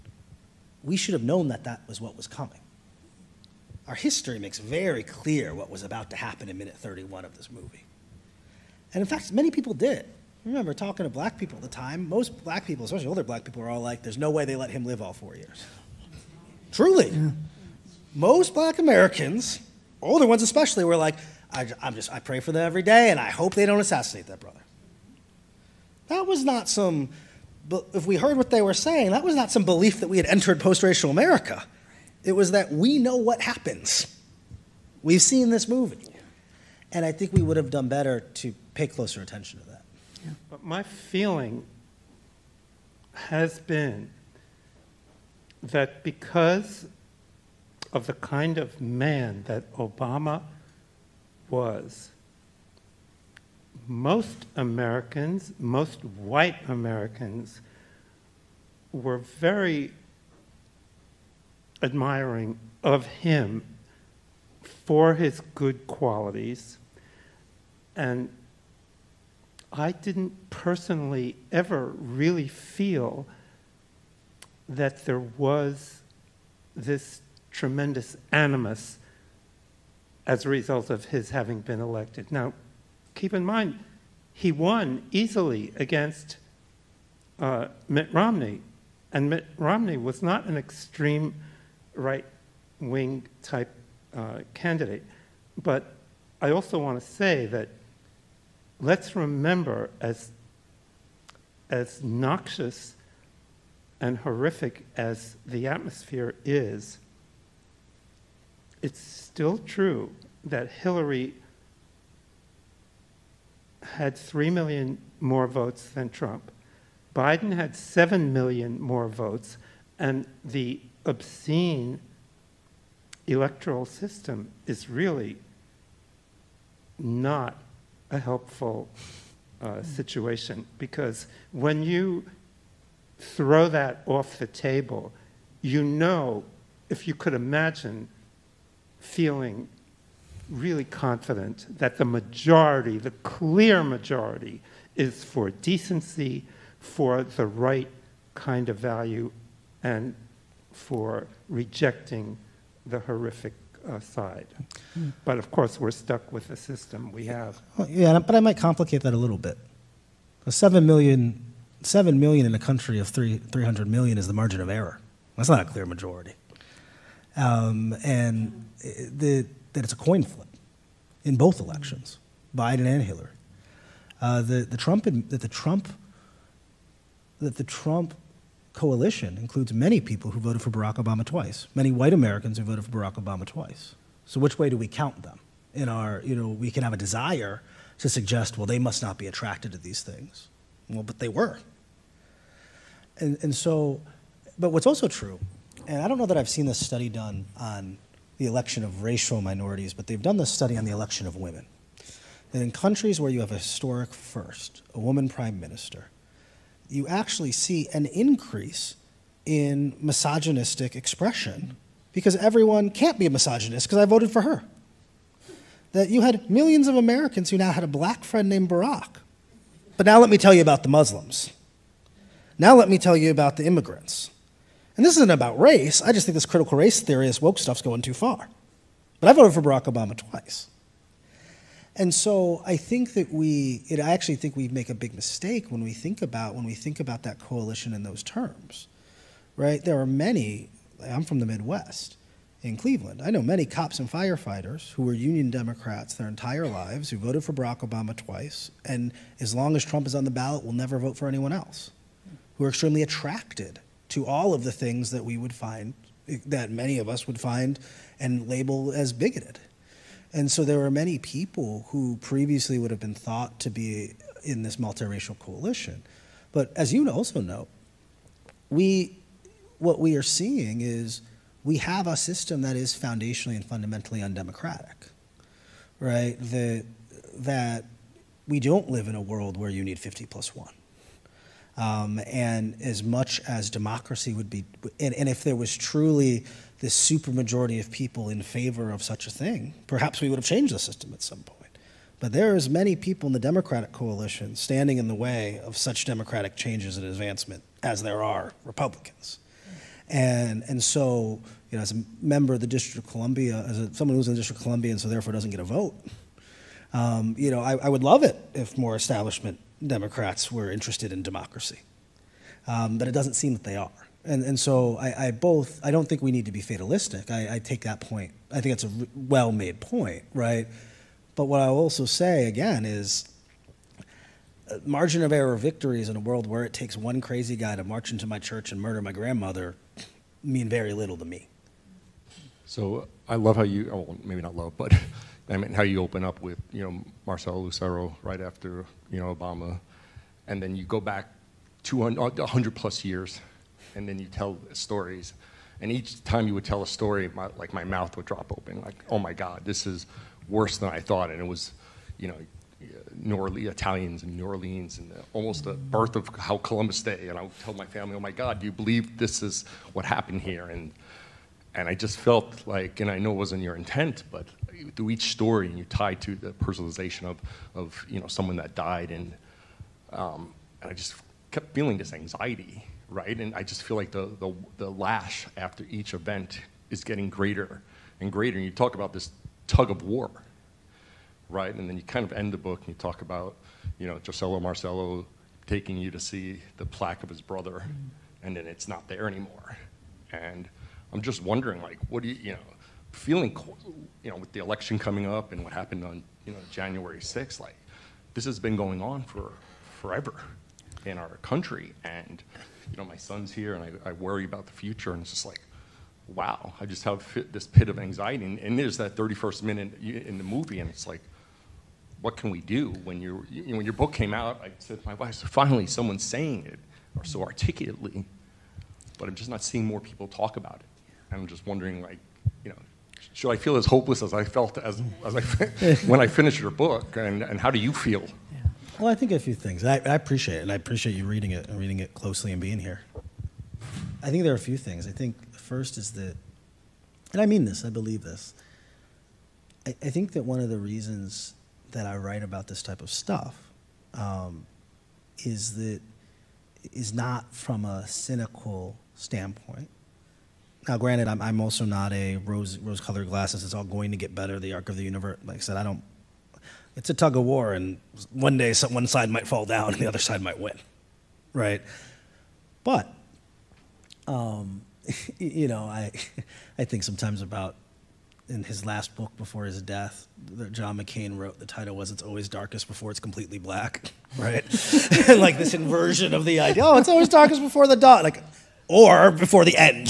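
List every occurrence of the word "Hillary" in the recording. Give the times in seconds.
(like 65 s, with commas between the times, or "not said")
110 s, 173 s.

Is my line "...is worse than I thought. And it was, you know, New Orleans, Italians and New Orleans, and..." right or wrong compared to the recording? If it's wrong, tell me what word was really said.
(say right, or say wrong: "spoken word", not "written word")
right.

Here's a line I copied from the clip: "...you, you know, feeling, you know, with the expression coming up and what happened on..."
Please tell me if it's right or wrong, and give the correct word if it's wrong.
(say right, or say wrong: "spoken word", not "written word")
wrong: "election", not "expression".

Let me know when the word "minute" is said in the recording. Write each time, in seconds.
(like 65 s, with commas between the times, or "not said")
6 s, 409 s.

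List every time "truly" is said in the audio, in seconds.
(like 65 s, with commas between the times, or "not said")
16 s, 285 s.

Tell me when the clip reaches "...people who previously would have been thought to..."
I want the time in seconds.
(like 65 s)
261 s.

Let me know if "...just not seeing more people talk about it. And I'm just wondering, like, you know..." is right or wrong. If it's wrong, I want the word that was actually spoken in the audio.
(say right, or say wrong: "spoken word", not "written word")
right.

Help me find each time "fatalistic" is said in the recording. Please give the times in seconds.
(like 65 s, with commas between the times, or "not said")
316 s.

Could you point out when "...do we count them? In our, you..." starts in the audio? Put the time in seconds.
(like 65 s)
184 s.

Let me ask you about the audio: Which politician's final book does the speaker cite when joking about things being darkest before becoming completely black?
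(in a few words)
John McCain.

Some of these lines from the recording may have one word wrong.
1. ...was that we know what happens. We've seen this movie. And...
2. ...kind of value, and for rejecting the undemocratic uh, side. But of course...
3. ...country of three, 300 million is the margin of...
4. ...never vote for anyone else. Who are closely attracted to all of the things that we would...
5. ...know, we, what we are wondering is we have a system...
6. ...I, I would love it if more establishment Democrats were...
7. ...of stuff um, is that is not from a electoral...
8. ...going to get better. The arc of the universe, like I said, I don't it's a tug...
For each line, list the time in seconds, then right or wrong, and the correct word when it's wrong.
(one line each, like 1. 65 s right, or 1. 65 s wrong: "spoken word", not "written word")
1. 32 s right
2. 148 s wrong: "horrific", not "undemocratic"
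3. 162 s right
4. 250 s wrong: "extremely", not "closely"
5. 267 s wrong: "seeing", not "wondering"
6. 307 s right
7. 443 s wrong: "cynical", not "electoral"
8. 453 s right.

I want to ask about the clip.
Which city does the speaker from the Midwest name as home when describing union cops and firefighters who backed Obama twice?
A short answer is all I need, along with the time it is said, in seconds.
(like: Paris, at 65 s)
Cleveland, at 242 s.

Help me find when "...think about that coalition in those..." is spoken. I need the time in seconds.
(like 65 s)
236 s.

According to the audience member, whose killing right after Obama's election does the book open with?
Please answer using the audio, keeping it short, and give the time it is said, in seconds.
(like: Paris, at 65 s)
Marcelo Lucero, at 337 s.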